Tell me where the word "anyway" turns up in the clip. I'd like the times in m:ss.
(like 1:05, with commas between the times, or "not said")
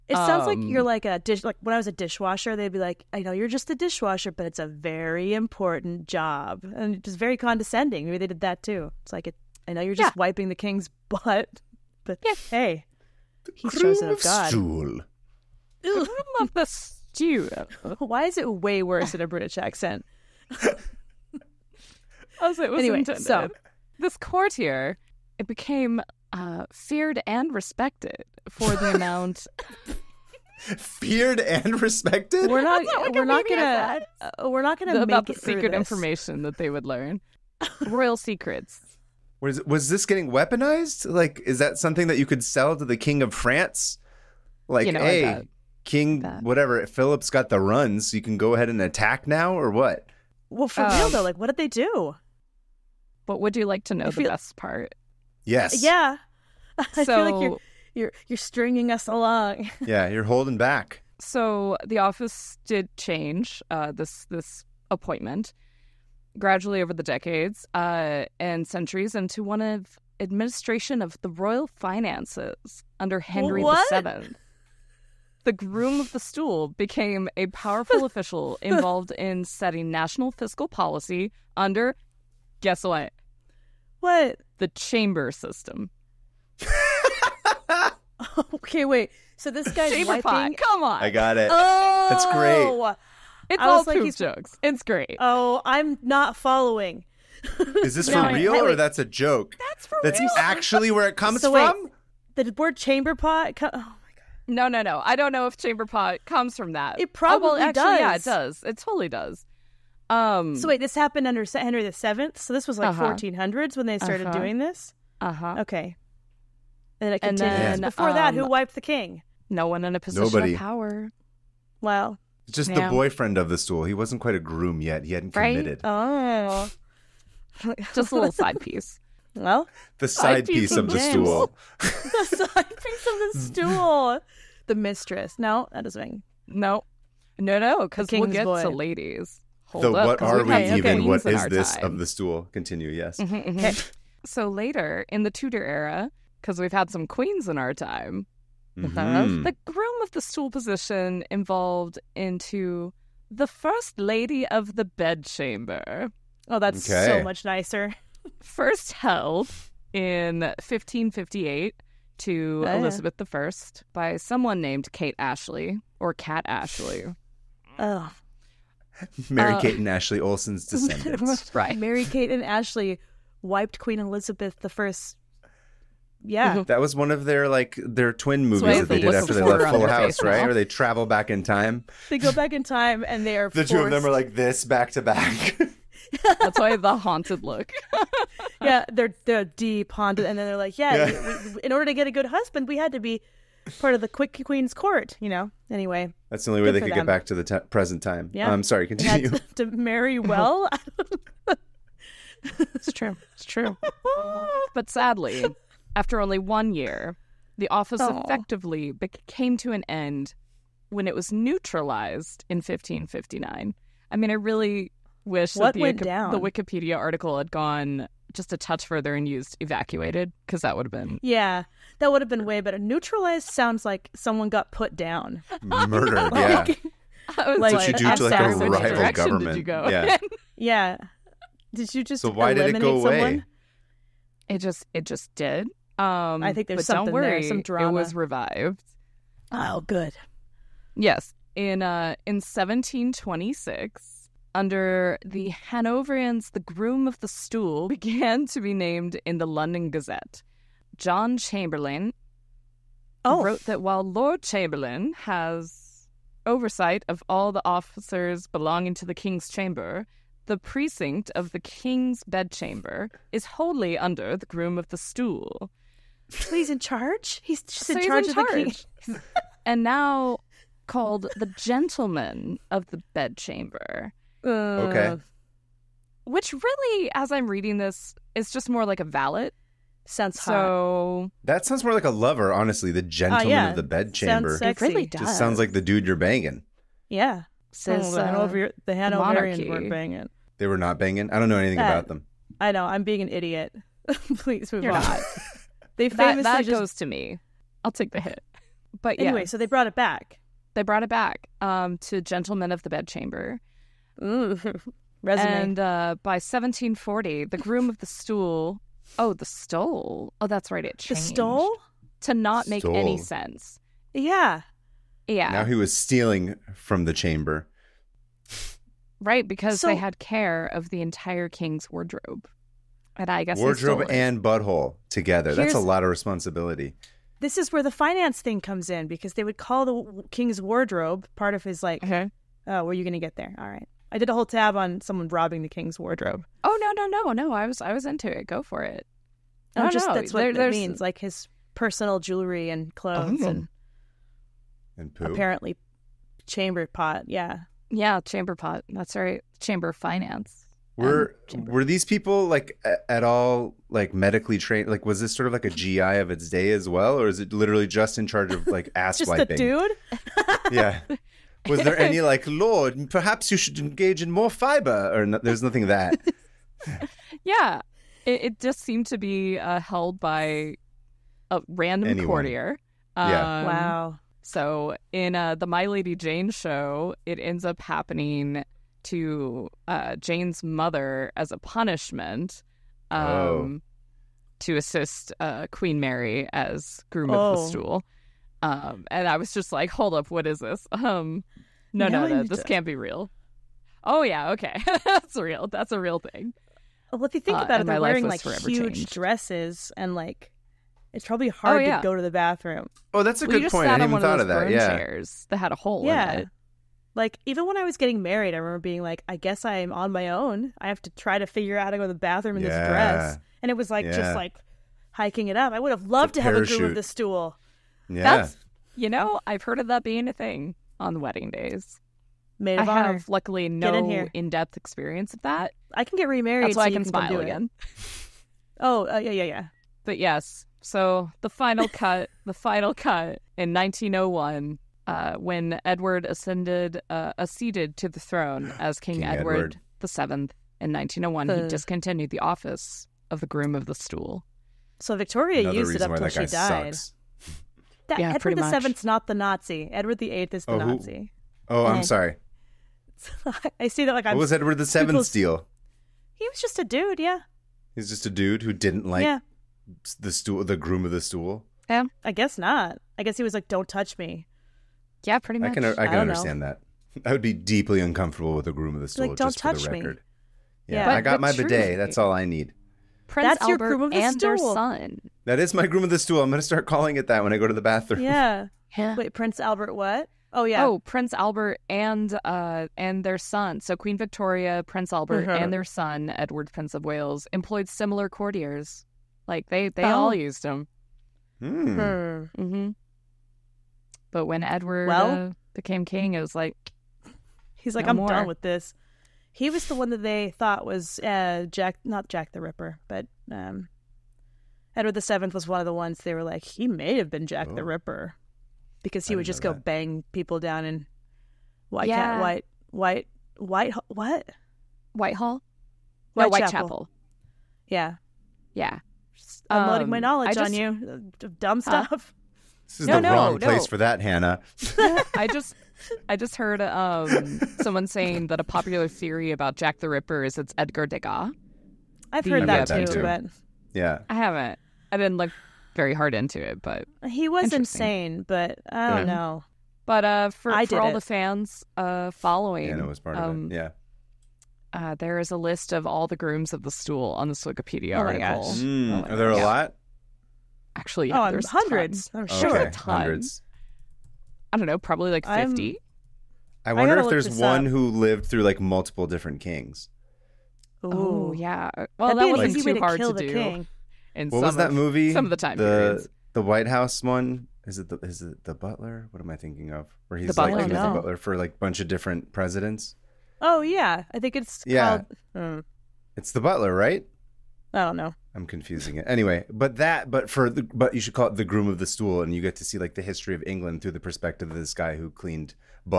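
0:22, 3:15, 4:59, 9:39.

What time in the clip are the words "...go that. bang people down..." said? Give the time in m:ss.
8:29.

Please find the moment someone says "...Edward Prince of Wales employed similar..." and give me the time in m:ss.
8:06.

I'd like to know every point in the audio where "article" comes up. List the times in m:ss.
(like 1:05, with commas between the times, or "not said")
3:36, 9:08.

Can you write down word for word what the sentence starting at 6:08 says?
It, it, just seemed to be uh, held by a random Anyone.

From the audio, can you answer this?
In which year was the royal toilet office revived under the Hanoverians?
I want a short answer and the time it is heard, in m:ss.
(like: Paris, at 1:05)
1726, at 4:02.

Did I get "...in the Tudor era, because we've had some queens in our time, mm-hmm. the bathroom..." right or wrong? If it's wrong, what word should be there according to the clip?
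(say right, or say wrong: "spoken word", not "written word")
wrong: "groom", not "bathroom".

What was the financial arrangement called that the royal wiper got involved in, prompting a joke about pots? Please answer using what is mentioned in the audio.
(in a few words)
The chamber system.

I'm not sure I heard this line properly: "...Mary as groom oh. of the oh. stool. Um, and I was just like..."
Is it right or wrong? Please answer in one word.
right.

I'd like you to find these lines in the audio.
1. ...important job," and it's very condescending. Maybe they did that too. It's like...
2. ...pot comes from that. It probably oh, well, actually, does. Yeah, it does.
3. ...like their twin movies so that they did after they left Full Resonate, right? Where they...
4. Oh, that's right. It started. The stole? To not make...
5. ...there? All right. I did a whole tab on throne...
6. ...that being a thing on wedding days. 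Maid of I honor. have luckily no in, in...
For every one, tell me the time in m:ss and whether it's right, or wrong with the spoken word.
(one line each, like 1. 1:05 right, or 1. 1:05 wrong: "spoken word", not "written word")
1. 0:05 right
2. 1:45 right
3. 2:57 wrong: "House", not "Resonate"
4. 5:10 wrong: "changed", not "started"
5. 5:33 wrong: "someone", not "throne"
6. 6:59 right.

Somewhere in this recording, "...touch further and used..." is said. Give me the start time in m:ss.
3:38.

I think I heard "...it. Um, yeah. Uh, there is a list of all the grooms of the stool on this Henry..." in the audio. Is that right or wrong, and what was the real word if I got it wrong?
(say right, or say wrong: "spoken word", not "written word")
wrong: "Wikipedia", not "Henry".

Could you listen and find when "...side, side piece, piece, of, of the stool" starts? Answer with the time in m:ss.
2:10.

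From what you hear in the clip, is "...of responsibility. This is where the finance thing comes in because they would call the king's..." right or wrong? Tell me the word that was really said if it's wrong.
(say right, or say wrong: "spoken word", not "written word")
right.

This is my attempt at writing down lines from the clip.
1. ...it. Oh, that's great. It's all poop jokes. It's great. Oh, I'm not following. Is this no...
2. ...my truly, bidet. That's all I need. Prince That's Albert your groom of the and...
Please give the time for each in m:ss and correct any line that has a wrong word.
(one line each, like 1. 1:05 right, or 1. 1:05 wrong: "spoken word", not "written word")
1. 1:31 right
2. 7:51 right.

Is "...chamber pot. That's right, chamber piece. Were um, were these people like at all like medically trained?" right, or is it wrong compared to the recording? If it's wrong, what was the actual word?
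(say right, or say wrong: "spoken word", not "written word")
wrong: "finance", not "piece".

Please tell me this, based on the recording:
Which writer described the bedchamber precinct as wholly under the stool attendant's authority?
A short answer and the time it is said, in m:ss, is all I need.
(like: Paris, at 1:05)
John Chamberlayne, at 4:10.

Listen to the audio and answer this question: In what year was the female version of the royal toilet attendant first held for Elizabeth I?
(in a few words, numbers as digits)
1558.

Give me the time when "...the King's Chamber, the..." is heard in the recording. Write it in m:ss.
4:19.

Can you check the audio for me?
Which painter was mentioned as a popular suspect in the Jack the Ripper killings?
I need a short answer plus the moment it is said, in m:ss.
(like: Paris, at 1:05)
Edgar Degas, at 8:50.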